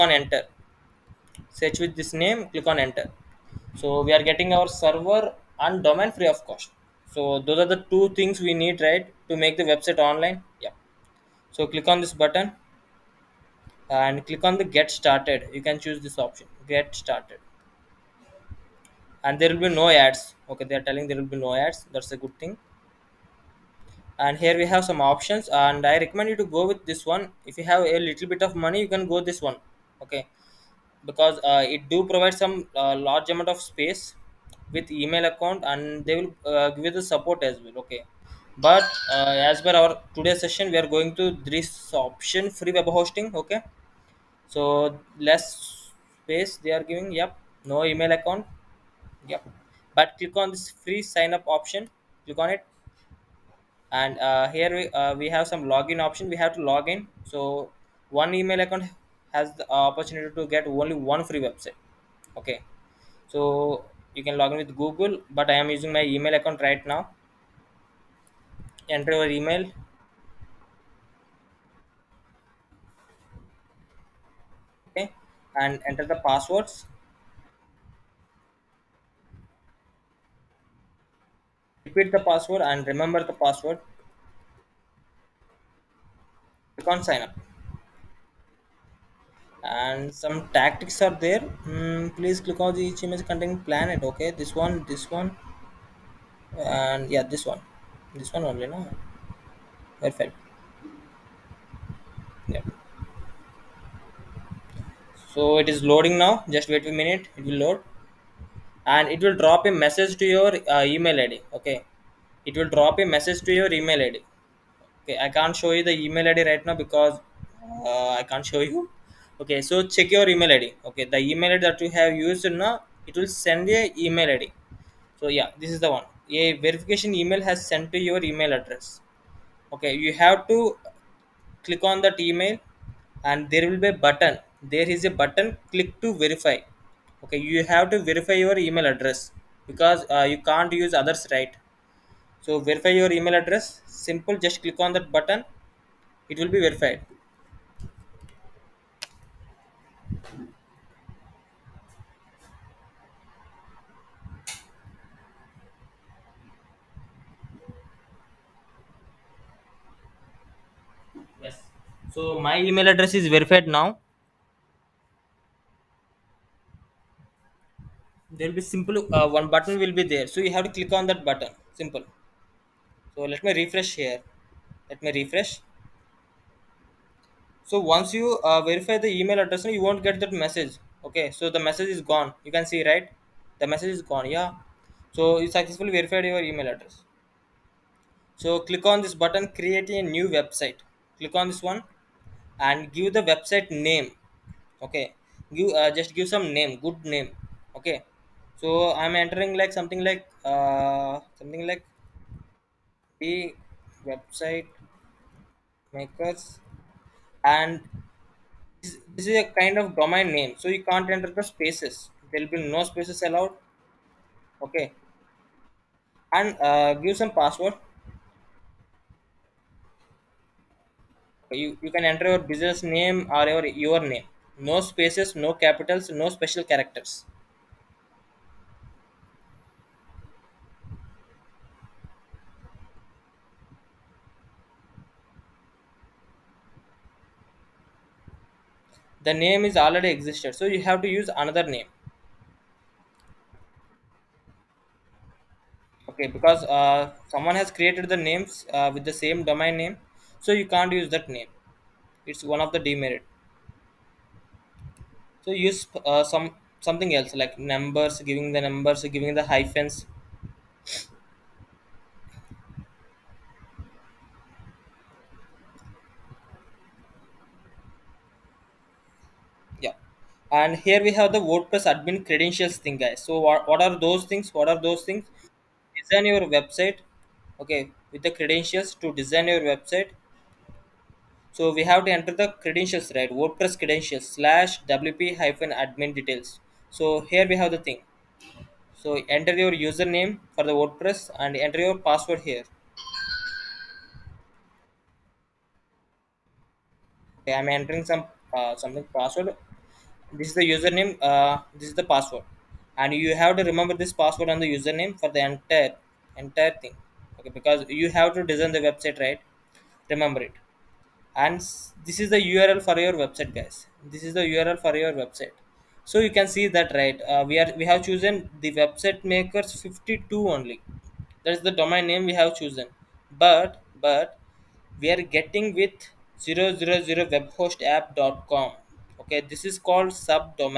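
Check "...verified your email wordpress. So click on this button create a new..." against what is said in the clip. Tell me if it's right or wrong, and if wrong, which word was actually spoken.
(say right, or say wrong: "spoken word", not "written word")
wrong: "address", not "wordpress".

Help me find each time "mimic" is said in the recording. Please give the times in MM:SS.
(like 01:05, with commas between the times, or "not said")
not said.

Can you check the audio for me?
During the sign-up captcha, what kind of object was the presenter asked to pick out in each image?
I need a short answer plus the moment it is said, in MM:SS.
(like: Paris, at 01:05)
planet, at 01:33.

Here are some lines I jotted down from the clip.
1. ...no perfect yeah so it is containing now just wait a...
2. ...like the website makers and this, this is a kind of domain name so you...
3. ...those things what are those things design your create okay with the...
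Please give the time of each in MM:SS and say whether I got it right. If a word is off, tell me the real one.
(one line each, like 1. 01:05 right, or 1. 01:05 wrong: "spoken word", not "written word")
1. 01:38 wrong: "loading", not "containing"
2. 03:21 right
3. 04:33 wrong: "website", not "create".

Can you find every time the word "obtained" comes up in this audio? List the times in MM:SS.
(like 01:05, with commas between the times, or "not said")
not said.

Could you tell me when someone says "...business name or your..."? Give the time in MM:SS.
03:42.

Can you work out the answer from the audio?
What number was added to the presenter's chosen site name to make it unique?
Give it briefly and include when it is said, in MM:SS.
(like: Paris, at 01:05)
52, at 05:19.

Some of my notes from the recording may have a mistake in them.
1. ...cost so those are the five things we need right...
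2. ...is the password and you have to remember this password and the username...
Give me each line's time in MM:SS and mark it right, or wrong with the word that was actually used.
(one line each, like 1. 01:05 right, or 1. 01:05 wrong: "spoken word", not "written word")
1. 00:06 wrong: "two", not "five"
2. 05:01 right.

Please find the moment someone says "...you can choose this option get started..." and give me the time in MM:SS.
00:15.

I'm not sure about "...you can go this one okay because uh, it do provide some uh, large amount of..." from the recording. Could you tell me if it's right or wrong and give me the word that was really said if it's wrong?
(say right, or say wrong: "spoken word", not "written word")
right.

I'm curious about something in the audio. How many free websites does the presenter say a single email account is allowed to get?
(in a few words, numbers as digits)
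1.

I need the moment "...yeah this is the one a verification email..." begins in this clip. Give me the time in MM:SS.
02:05.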